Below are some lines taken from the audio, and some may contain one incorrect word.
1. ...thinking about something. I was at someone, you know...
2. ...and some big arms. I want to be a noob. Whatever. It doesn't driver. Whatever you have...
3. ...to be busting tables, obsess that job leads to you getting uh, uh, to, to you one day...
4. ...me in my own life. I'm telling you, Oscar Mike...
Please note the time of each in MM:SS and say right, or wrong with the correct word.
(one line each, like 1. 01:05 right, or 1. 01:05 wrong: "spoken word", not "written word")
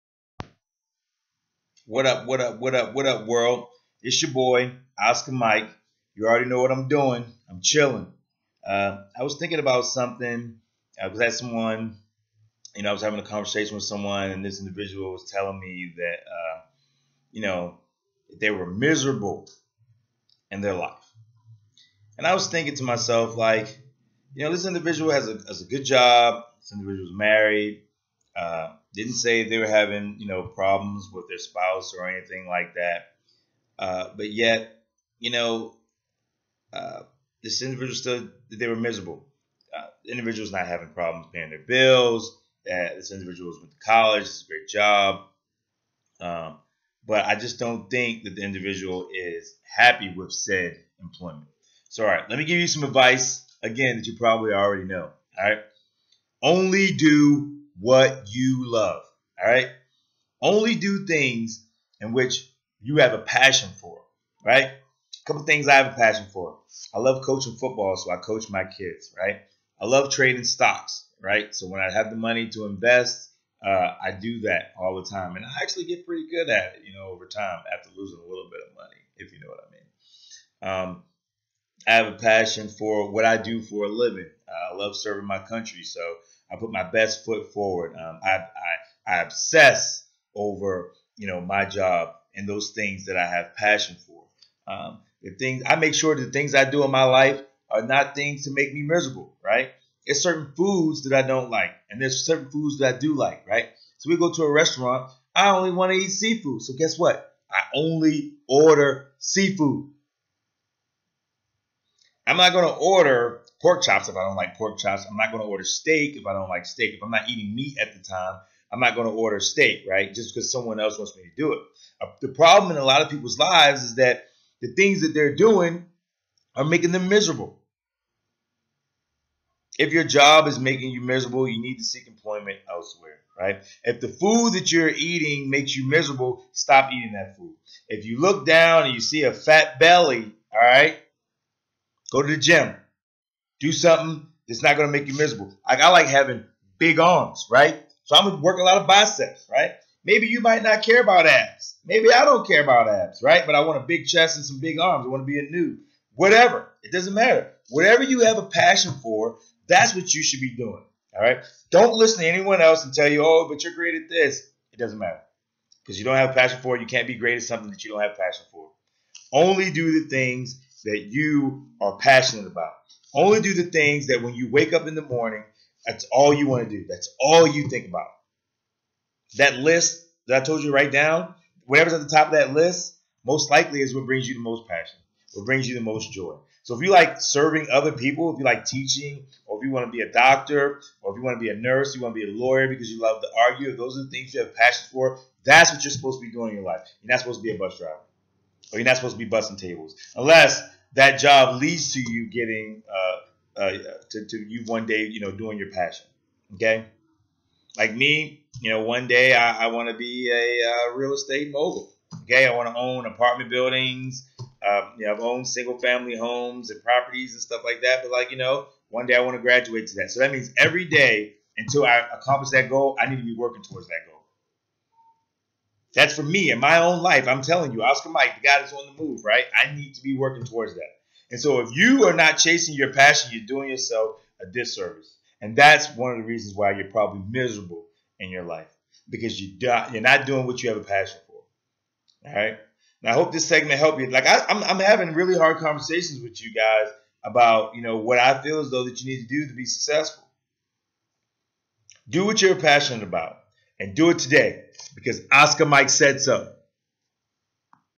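1. 00:09 right
2. 02:34 wrong: "matter", not "driver"
3. 03:19 wrong: "unless", not "obsess"
4. 03:46 right.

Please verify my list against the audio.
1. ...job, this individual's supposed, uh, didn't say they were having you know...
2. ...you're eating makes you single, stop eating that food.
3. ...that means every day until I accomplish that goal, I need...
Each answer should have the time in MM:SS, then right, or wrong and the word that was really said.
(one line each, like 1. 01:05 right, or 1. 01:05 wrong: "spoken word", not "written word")
1. 00:25 wrong: "married", not "supposed"
2. 02:14 wrong: "miserable", not "single"
3. 03:40 right.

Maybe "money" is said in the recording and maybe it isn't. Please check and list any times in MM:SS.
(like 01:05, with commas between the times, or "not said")
01:12, 01:18.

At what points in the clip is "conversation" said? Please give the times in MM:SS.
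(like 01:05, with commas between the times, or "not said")
00:13, 04:05.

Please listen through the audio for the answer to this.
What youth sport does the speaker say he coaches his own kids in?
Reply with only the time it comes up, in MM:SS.
01:07.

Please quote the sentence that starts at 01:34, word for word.
Um, the things I make sure the things I do in my life are not things to make me miserable, right?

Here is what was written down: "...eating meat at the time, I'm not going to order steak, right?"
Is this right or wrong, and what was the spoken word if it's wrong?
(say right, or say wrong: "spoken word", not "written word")
right.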